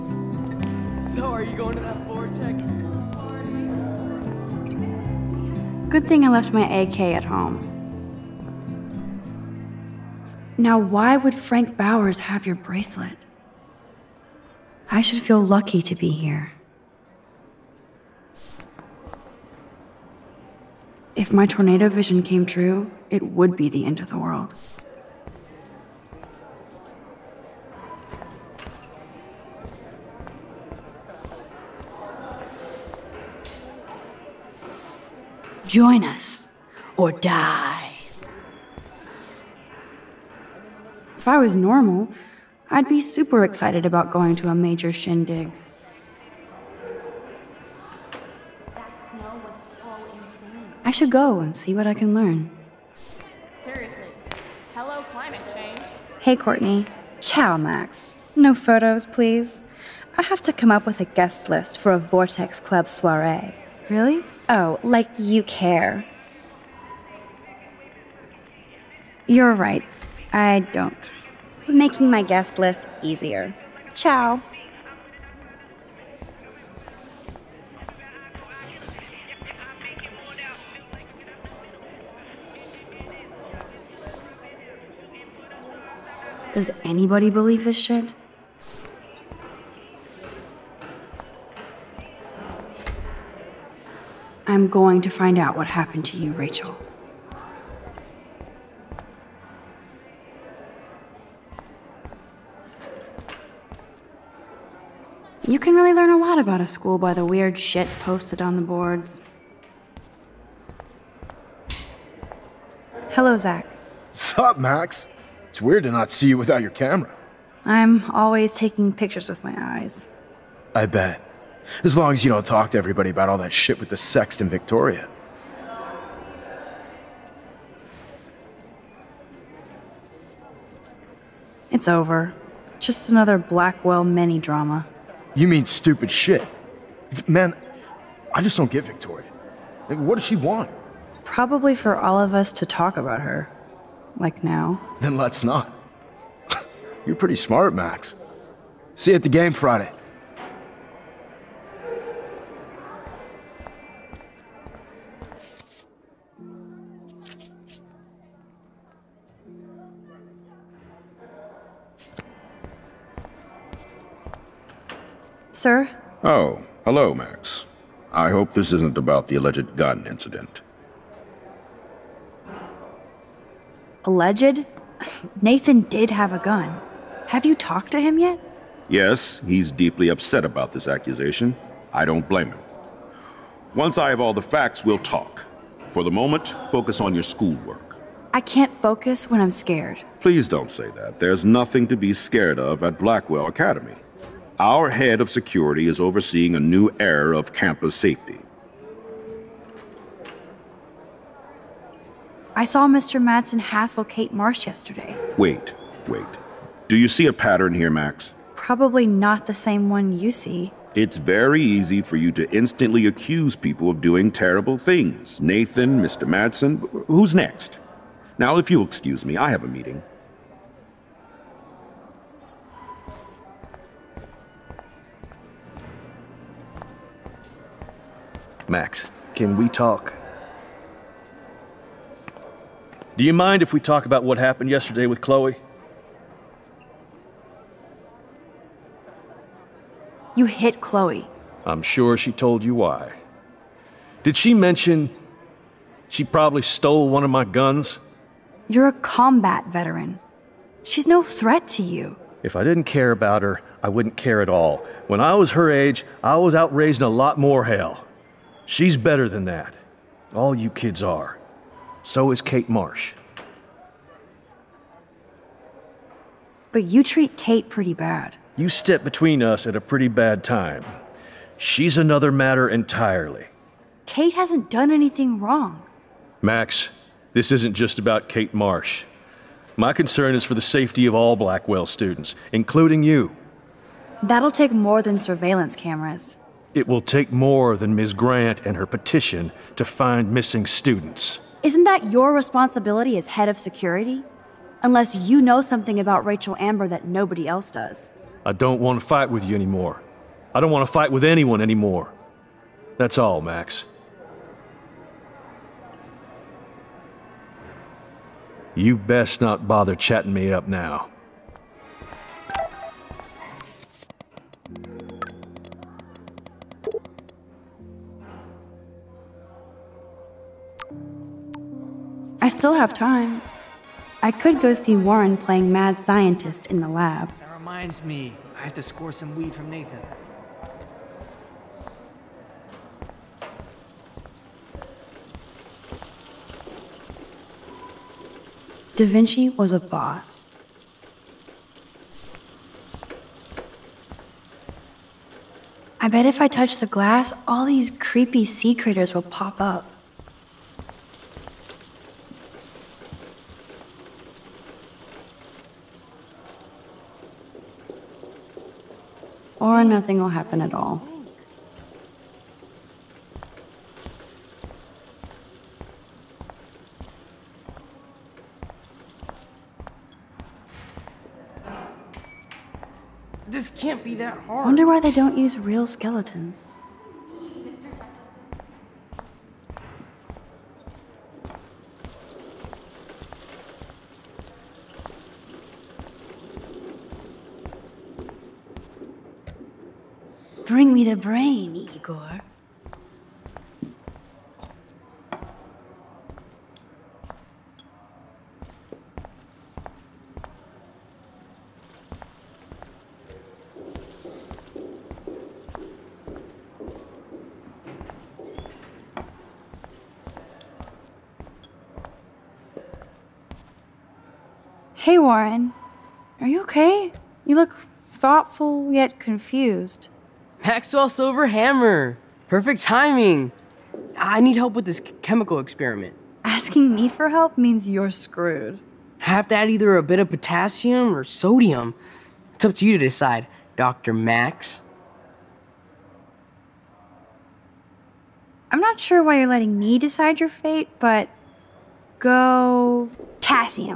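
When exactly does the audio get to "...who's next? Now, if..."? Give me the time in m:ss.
3:37.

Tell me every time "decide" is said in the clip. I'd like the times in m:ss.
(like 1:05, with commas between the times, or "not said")
7:13, 7:19.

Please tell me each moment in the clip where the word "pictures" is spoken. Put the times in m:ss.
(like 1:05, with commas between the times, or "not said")
1:58.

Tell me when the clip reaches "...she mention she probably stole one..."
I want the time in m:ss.
4:04.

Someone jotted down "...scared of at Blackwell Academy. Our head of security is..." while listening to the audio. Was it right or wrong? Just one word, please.
right.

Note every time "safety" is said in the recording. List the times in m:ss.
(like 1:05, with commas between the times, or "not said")
3:17, 4:40.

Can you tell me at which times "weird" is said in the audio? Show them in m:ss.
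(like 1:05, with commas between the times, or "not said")
1:47, 1:55.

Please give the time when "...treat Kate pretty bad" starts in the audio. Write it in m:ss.
4:27.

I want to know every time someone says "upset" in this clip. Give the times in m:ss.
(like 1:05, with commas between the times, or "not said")
3:00.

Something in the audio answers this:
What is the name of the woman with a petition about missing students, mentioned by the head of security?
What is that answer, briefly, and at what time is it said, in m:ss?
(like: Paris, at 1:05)
Ms. Grant, at 4:47.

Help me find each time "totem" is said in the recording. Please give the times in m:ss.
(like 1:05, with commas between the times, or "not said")
not said.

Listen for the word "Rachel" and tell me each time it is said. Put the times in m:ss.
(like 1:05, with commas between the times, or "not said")
1:36, 4:56.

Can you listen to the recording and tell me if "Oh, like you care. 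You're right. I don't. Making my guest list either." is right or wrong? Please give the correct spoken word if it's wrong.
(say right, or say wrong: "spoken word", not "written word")
wrong: "easier", not "either".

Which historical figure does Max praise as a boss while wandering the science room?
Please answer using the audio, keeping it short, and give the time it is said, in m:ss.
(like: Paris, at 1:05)
Da Vinci, at 5:38.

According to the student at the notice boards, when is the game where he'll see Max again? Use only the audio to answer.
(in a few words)
Friday.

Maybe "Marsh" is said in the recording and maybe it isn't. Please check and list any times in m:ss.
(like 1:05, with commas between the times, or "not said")
3:24, 4:22, 4:38.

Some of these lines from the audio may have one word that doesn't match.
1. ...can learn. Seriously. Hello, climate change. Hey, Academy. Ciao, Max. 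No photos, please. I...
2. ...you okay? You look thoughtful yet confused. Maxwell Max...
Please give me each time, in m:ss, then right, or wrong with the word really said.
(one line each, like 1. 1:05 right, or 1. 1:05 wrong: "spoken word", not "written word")
1. 0:51 wrong: "Courtney", not "Academy"
2. 6:56 wrong: "Silver", not "Max".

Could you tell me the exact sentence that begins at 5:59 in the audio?
or nothing will happen at all.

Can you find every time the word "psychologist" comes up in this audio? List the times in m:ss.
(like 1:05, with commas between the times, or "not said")
not said.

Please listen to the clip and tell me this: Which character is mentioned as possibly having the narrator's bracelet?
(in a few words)
Frank Bowers.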